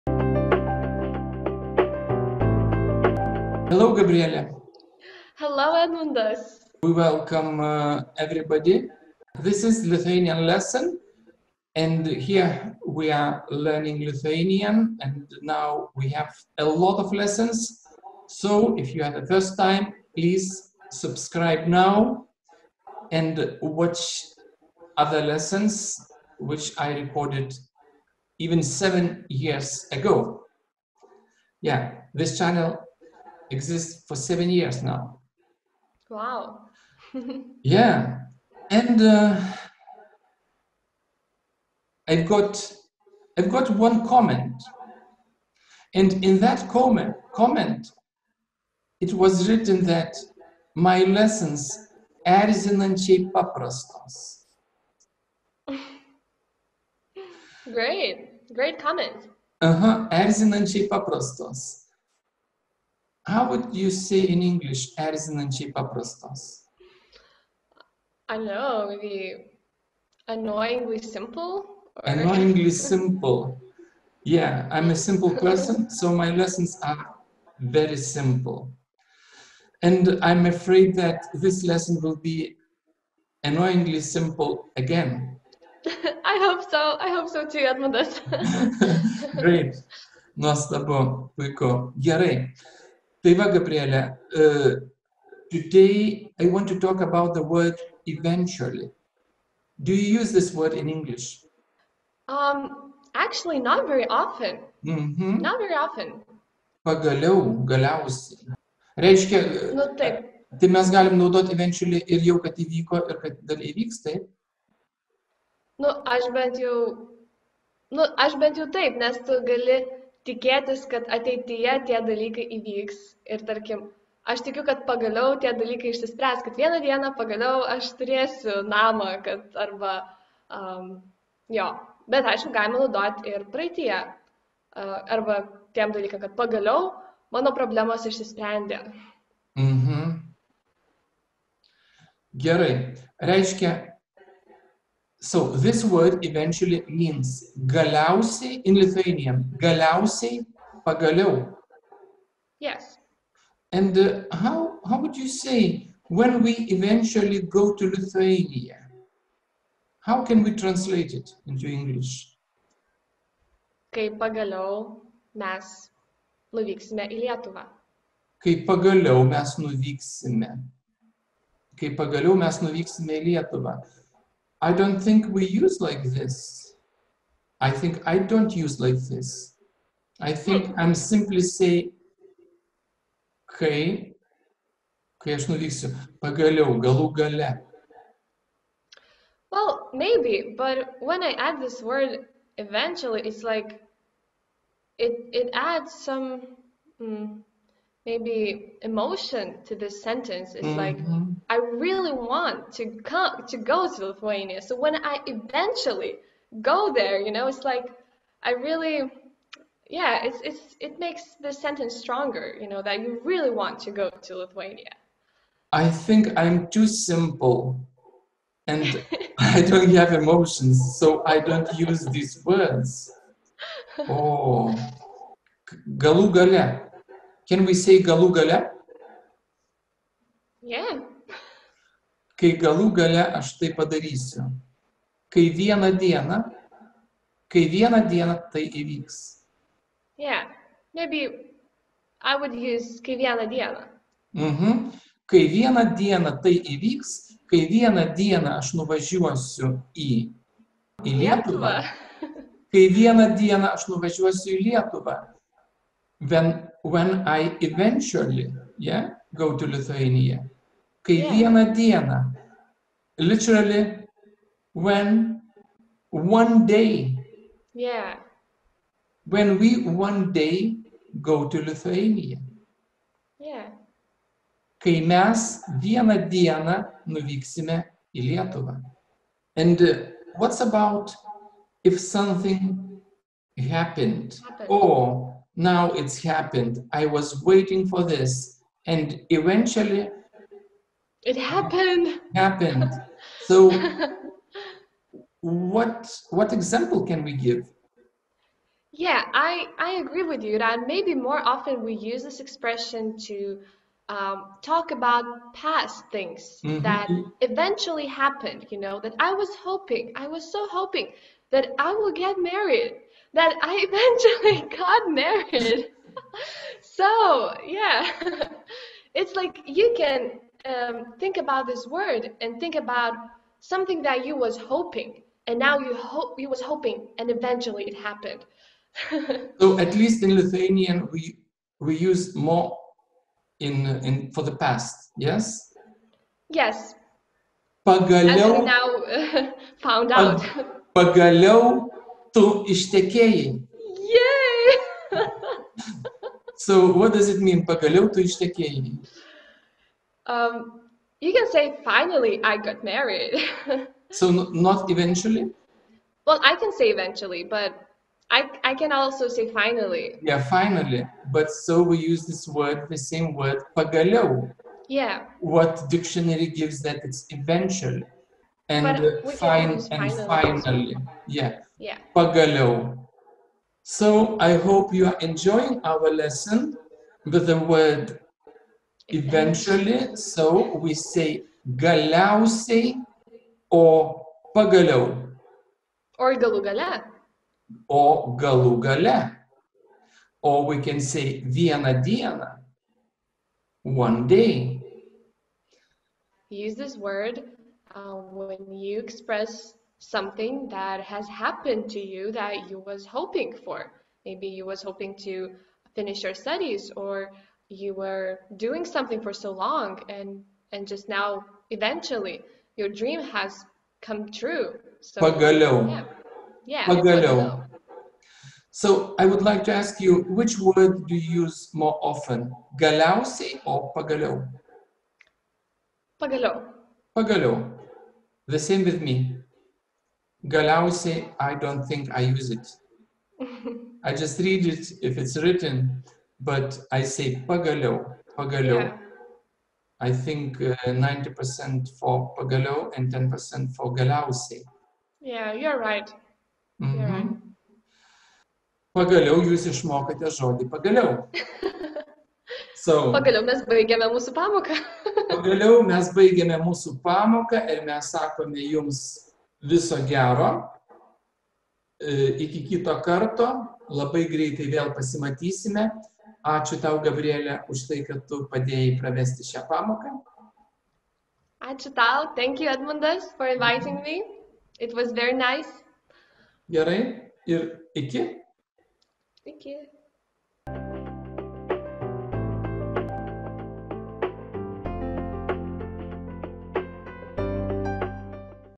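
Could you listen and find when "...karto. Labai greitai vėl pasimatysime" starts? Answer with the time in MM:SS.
07:43.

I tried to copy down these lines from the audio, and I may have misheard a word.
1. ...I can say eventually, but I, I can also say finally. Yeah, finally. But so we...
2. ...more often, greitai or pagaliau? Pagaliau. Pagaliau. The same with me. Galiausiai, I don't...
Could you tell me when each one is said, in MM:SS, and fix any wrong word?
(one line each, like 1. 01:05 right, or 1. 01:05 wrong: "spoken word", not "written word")
1. 05:56 right
2. 07:01 wrong: "galiausiai", not "greitai".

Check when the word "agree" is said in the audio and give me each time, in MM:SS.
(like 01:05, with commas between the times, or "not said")
05:00.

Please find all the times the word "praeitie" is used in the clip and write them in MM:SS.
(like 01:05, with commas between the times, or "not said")
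02:13.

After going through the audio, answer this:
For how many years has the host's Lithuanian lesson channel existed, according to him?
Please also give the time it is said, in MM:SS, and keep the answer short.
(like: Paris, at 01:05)
7, at 00:34.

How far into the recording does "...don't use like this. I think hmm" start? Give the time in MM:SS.
02:58.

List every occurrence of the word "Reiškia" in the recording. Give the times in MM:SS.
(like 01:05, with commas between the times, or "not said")
01:48, 02:23.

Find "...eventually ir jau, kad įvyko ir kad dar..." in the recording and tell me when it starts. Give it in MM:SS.
01:51.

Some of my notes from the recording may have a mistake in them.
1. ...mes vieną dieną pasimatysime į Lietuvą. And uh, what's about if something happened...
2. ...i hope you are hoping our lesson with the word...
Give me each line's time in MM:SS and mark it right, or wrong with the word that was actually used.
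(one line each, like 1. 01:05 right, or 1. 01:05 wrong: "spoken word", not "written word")
1. 04:35 wrong: "nuvyksime", not "pasimatysime"
2. 06:14 wrong: "enjoying", not "hoping".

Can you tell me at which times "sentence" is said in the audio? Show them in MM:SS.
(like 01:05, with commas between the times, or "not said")
03:20, 03:31.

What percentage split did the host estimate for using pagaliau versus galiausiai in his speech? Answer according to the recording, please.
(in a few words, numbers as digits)
90% and 10%.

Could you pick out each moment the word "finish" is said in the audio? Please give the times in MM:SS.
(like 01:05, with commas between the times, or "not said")
06:45.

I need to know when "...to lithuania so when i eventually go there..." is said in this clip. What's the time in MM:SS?
03:23.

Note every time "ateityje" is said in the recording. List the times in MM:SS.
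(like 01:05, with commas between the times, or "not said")
02:01.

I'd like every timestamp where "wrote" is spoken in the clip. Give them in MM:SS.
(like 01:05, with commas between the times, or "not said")
not said.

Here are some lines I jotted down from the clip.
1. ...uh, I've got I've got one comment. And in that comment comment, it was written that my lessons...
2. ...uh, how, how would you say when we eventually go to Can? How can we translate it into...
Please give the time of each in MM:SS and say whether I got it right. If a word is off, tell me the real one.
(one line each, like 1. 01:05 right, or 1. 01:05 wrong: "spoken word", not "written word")
1. 00:39 right
2. 02:33 wrong: "Lithuania", not "Can".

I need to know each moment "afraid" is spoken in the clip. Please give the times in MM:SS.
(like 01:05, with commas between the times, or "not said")
01:20.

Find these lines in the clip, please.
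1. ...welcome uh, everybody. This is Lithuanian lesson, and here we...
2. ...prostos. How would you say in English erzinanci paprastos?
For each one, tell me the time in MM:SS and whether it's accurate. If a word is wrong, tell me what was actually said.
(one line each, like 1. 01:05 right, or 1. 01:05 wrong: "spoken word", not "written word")
1. 00:06 right
2. 01:00 right.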